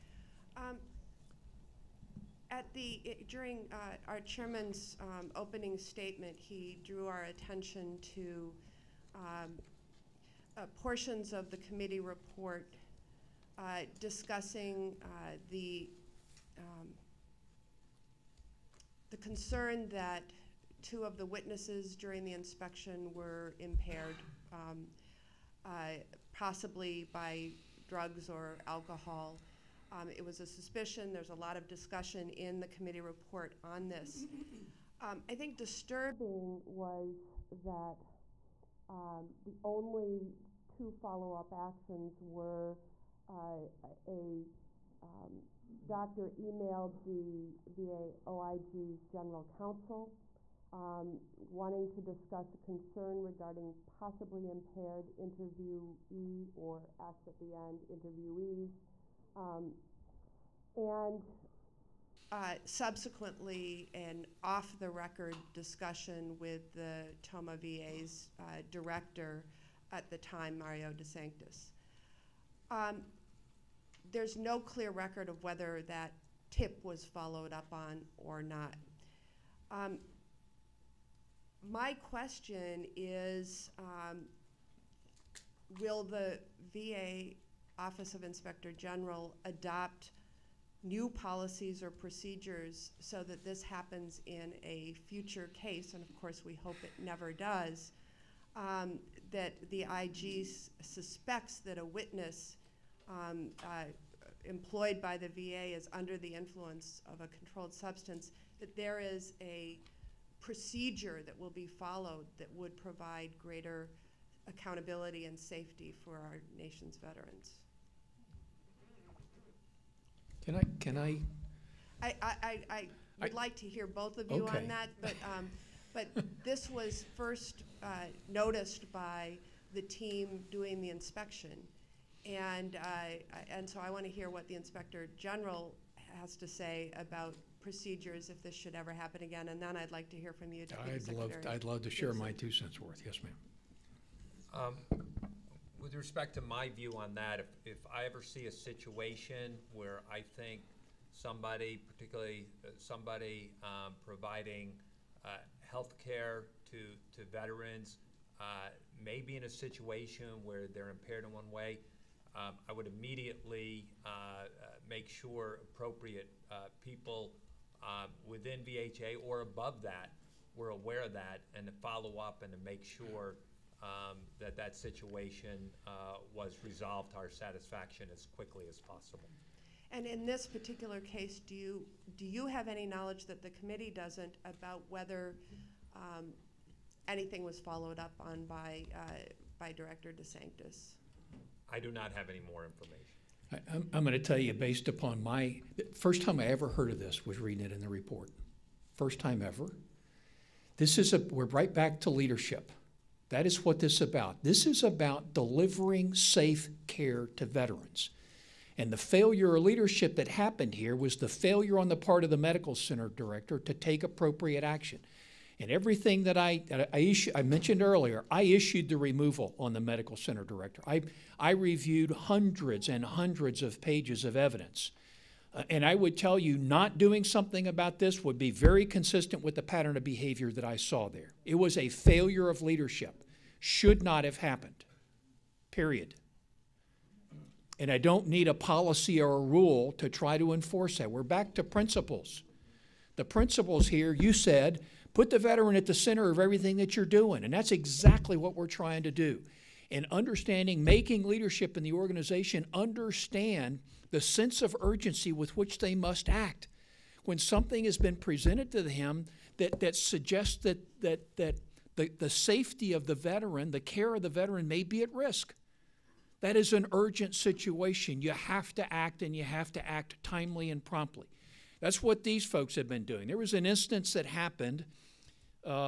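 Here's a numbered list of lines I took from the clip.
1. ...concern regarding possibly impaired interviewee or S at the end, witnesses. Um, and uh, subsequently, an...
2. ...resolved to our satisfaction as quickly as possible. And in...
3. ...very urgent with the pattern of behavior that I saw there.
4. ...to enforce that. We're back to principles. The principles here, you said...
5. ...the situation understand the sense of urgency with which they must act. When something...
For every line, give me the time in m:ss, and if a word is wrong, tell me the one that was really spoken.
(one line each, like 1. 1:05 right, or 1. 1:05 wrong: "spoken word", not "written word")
1. 0:52 wrong: "interviewees", not "witnesses"
2. 2:56 right
3. 3:48 wrong: "consistent", not "urgent"
4. 4:00 right
5. 4:11 wrong: "organization", not "situation".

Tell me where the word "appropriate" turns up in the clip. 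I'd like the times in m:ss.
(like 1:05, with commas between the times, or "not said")
2:45, 3:34.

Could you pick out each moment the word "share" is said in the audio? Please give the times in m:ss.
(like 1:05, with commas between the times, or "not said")
2:21.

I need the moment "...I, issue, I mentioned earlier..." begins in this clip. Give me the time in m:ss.
3:36.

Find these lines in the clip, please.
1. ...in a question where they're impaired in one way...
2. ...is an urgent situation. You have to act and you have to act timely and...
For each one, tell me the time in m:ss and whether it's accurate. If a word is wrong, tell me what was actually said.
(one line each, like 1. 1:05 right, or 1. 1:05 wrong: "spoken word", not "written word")
1. 2:39 wrong: "situation", not "question"
2. 4:26 right.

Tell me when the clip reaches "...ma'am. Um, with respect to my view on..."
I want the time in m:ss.
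2:23.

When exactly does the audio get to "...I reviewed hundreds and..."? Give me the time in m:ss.
3:41.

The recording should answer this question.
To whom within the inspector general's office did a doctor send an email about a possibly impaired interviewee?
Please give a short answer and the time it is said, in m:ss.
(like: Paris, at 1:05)
general counsel, at 0:49.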